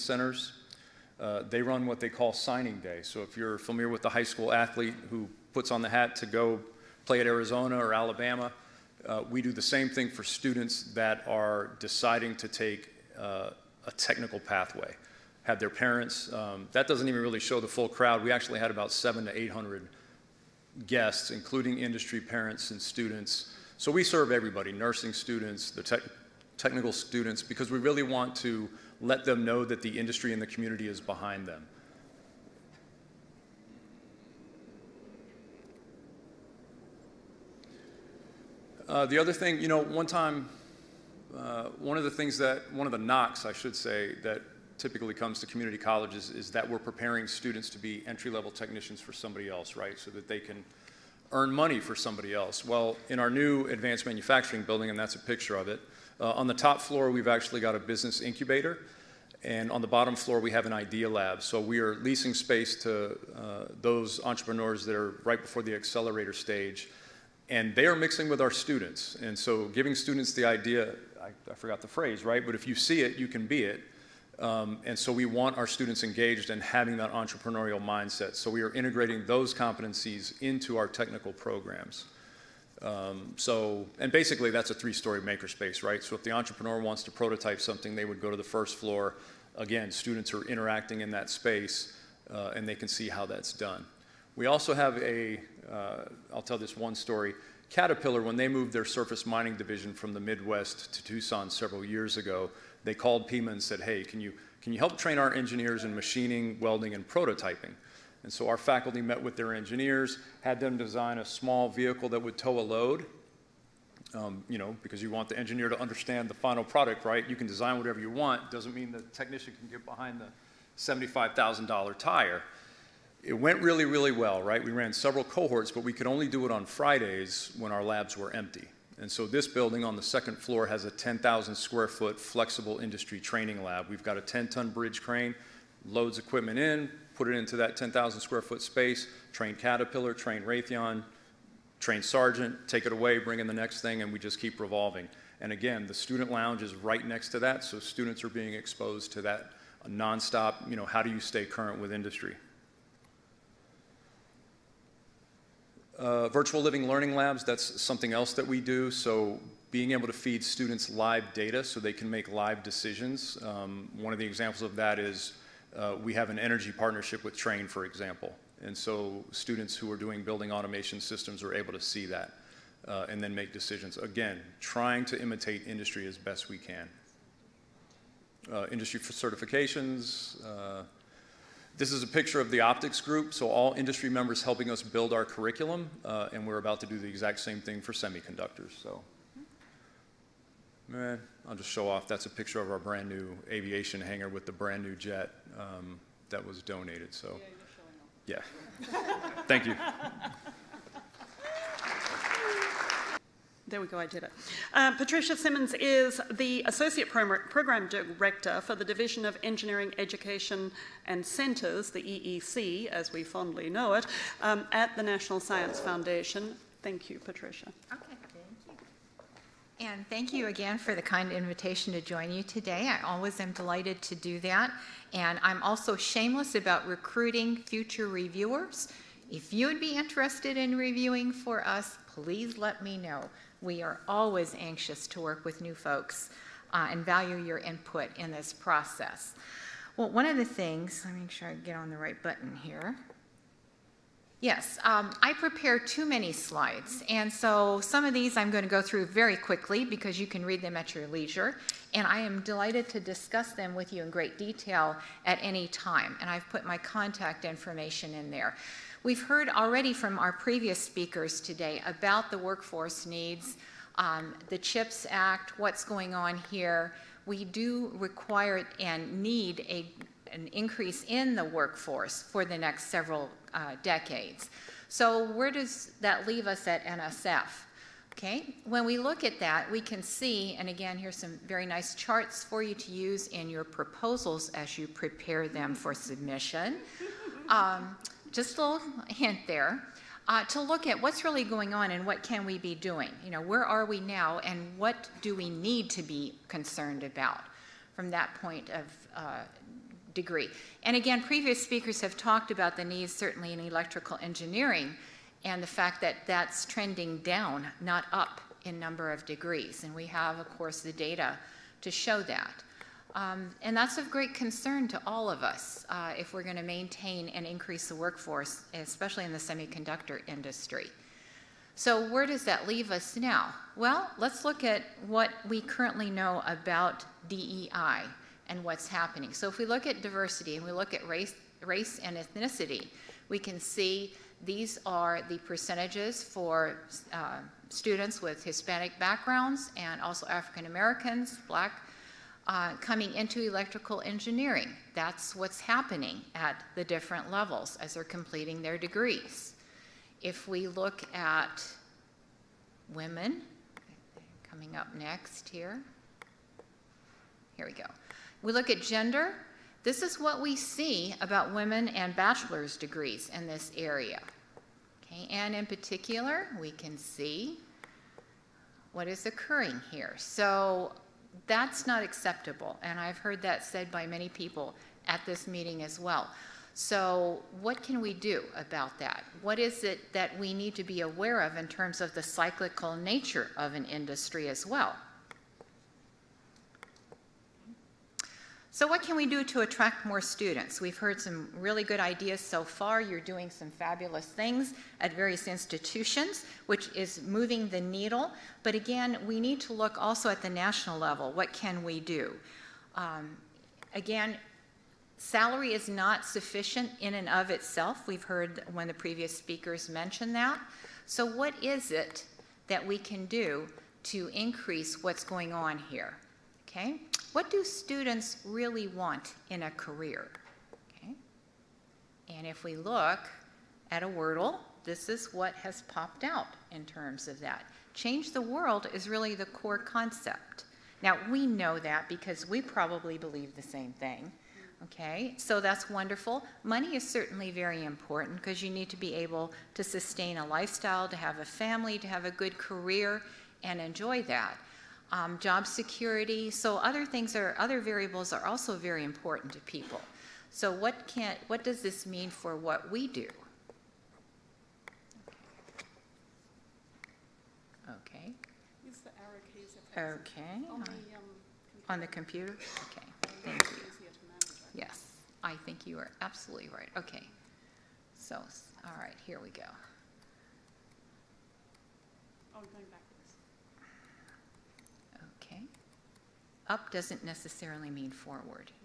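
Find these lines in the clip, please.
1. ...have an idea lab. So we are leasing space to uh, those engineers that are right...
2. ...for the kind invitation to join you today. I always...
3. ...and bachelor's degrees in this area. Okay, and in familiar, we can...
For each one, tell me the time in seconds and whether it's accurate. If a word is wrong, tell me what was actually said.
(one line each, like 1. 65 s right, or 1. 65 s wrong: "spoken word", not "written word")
1. 60 s wrong: "entrepreneurs", not "engineers"
2. 220 s right
3. 361 s wrong: "particular", not "familiar".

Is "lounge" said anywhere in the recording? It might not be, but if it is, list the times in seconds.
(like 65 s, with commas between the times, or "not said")
146 s.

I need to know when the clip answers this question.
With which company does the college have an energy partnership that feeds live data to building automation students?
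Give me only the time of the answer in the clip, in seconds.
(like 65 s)
167 s.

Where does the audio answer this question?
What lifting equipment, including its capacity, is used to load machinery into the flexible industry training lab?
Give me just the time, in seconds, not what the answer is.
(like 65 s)
134 s.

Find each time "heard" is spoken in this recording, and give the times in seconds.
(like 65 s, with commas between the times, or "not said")
259 s, 373 s, 390 s, 408 s.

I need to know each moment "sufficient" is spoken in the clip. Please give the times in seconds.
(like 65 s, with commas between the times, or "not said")
406 s.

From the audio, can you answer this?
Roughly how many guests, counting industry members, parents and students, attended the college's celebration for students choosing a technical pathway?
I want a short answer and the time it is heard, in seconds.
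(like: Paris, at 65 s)
700 to 800, at 18 s.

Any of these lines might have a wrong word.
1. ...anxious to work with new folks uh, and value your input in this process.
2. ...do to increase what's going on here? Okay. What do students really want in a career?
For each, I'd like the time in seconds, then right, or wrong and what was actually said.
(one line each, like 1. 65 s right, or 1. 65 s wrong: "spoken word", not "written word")
1. 234 s right
2. 413 s right.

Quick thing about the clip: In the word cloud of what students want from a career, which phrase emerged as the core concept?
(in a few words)
Change the world.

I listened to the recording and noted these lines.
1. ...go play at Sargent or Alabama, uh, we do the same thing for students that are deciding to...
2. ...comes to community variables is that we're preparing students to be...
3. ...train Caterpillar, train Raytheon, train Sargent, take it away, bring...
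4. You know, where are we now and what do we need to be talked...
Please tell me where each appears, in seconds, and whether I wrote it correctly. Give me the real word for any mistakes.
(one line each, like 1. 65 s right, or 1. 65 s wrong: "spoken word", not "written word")
1. 6 s wrong: "Arizona", not "Sargent"
2. 45 s wrong: "colleges", not "variables"
3. 139 s right
4. 293 s wrong: "concerned", not "talked".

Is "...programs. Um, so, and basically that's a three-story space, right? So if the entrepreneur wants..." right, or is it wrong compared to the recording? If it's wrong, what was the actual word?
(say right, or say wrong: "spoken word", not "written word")
wrong: "makerspace", not "space".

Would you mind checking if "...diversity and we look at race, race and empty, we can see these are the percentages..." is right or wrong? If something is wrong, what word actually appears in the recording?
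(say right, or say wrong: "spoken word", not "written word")
wrong: "ethnicity", not "empty".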